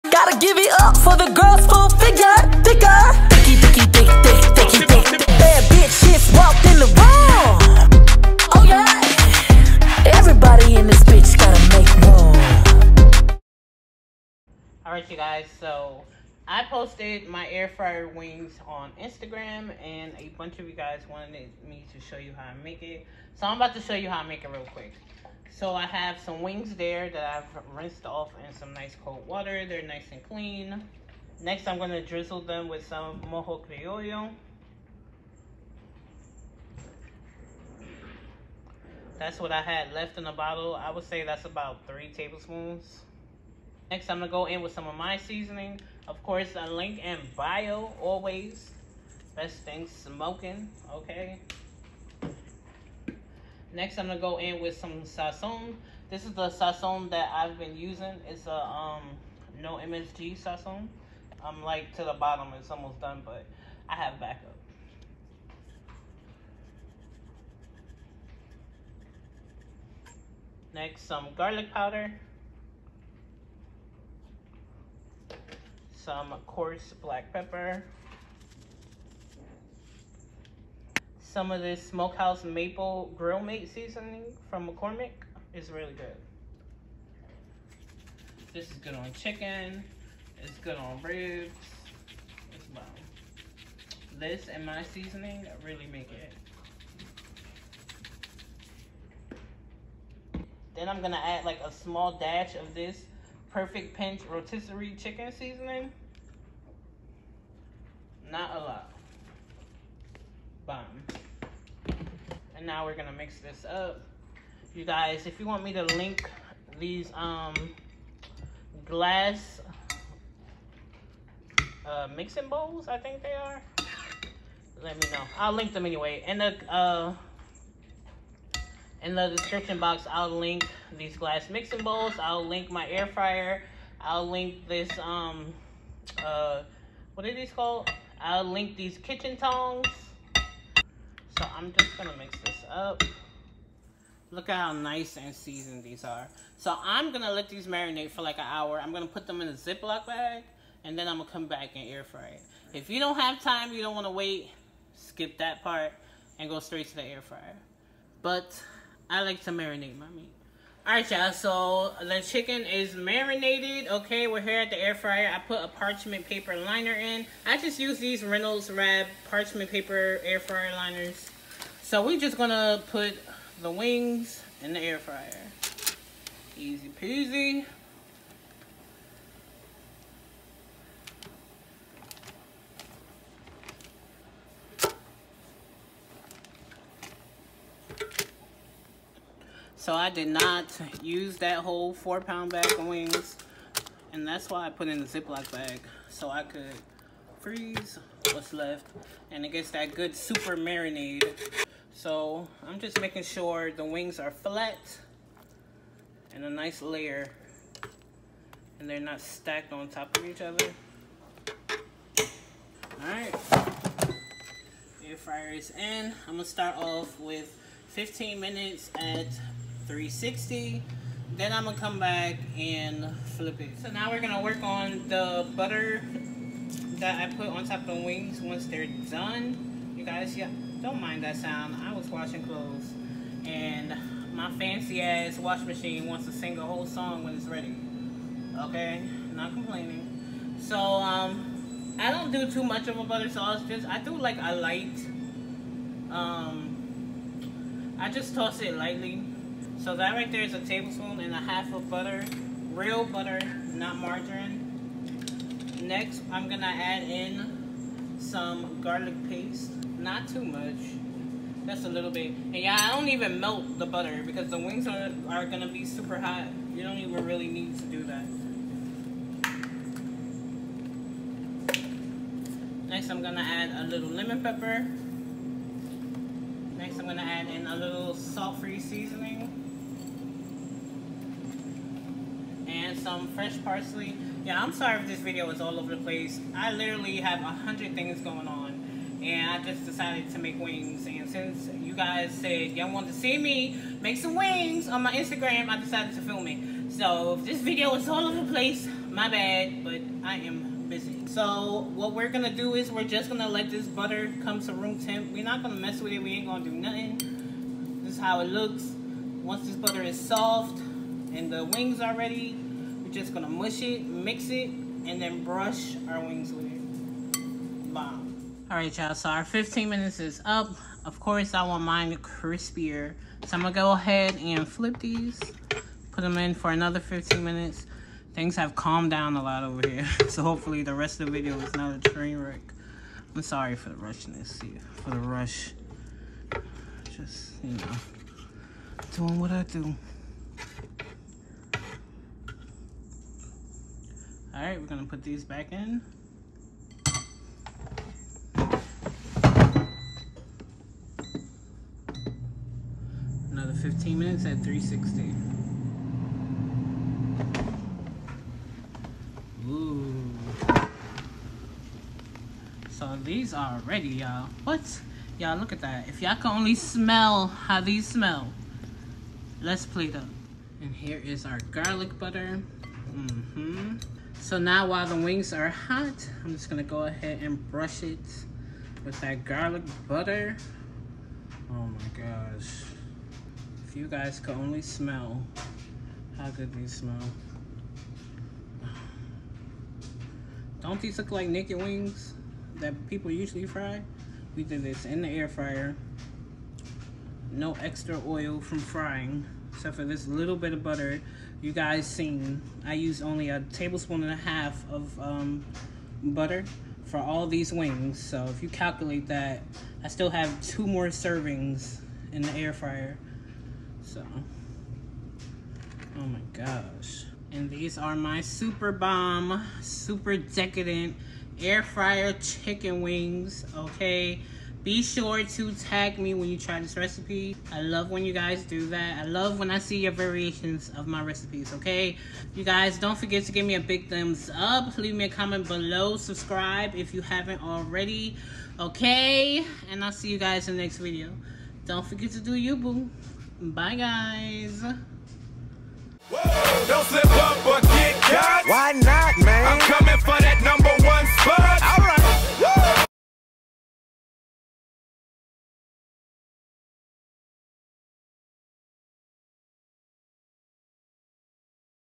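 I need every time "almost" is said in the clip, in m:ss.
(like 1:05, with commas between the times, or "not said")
1:02.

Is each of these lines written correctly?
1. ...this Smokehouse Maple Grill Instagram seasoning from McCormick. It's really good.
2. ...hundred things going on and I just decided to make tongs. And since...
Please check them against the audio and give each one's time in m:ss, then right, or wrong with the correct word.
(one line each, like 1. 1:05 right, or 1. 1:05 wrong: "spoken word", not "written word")
1. 1:21 wrong: "Mate", not "Instagram"
2. 4:47 wrong: "wings", not "tongs".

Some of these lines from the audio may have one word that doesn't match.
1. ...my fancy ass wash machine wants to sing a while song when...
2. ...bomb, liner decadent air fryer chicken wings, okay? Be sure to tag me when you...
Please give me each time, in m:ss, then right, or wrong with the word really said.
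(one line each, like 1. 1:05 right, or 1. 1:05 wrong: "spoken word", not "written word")
1. 3:54 wrong: "whole", not "while"
2. 6:58 wrong: "super", not "liner".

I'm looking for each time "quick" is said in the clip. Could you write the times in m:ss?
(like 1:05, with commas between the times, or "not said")
0:24.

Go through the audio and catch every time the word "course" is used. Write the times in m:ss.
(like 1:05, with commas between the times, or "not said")
0:46, 5:21.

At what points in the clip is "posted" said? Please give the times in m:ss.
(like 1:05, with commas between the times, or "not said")
0:16.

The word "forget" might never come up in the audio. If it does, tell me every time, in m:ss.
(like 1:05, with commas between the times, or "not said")
7:13, 7:22.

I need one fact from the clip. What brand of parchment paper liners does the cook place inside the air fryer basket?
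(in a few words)
Reynolds Wrap.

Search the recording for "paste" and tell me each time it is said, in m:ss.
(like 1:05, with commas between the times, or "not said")
4:19.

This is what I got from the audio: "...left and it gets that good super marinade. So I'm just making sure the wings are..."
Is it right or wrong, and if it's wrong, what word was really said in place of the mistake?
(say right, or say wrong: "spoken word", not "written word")
right.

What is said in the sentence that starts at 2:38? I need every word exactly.
But I like to marinate my meat.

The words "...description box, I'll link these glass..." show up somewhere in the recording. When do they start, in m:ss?
2:09.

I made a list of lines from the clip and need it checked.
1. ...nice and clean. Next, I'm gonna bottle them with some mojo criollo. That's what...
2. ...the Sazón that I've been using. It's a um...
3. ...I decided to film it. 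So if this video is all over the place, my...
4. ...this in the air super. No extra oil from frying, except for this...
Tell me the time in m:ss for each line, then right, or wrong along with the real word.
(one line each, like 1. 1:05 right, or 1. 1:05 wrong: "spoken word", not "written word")
1. 0:29 wrong: "drizzle", not "bottle"
2. 0:56 right
3. 4:55 right
4. 6:34 wrong: "fryer", not "super".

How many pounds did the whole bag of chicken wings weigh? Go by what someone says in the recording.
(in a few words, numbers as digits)
4 pounds.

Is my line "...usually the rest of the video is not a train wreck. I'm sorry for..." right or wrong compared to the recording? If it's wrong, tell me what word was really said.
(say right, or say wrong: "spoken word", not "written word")
wrong: "hopefully", not "usually".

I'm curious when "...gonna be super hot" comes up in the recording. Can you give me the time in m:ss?
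4:25.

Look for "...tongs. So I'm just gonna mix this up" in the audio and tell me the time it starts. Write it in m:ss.
2:19.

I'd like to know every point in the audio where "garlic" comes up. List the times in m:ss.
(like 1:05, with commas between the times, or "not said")
1:11, 4:18, 6:11, 6:19.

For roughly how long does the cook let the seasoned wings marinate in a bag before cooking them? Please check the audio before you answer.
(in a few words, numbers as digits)
an hour.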